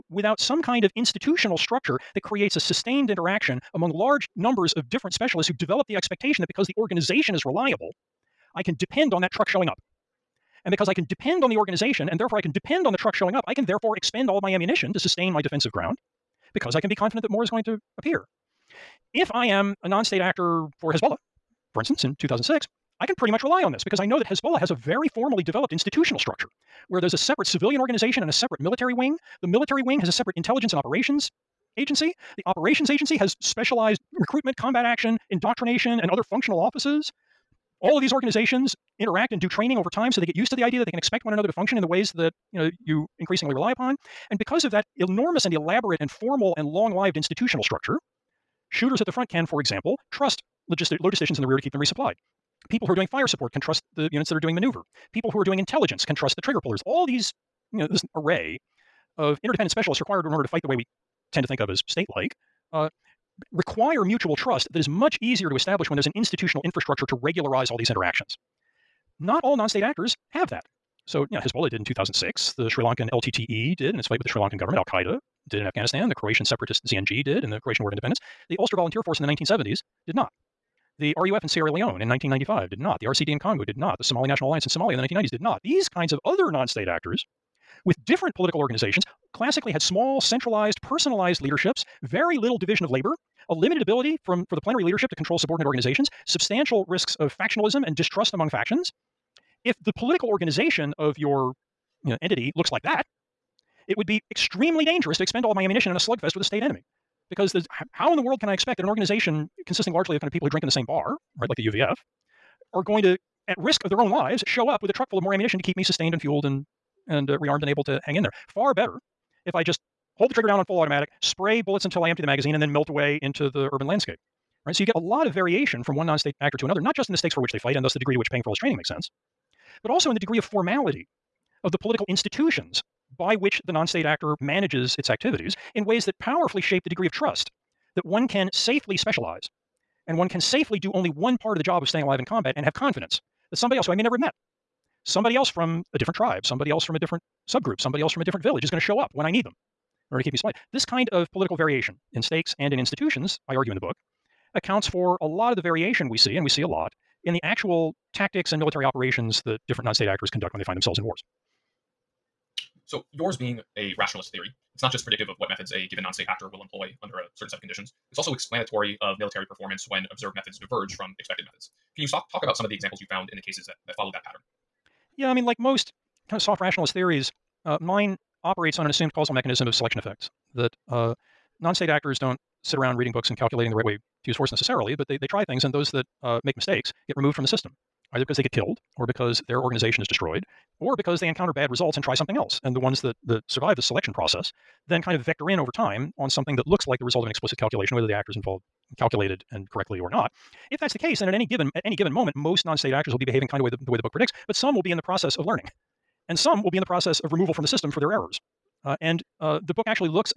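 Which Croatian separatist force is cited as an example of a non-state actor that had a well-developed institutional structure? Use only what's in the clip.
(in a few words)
ZNG.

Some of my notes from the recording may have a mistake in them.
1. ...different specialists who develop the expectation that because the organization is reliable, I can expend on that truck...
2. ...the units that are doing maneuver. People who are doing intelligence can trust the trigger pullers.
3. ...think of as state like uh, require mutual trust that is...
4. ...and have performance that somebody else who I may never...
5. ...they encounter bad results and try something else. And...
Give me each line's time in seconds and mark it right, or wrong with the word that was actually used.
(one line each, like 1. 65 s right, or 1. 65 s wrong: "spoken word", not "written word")
1. 4 s wrong: "depend", not "expend"
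2. 53 s right
3. 61 s right
4. 142 s wrong: "confidence", not "performance"
5. 191 s right.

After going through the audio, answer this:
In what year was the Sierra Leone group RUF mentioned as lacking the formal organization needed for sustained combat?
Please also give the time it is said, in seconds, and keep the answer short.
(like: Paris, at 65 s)
1995, at 82 s.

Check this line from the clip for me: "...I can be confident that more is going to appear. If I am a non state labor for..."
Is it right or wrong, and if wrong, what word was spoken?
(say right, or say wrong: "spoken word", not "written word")
wrong: "actor", not "labor".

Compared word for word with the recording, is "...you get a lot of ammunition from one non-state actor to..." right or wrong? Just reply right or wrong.
wrong.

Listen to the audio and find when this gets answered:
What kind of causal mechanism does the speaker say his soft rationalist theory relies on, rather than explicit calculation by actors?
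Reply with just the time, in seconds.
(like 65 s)
179 s.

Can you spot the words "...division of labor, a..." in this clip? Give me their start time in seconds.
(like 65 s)
92 s.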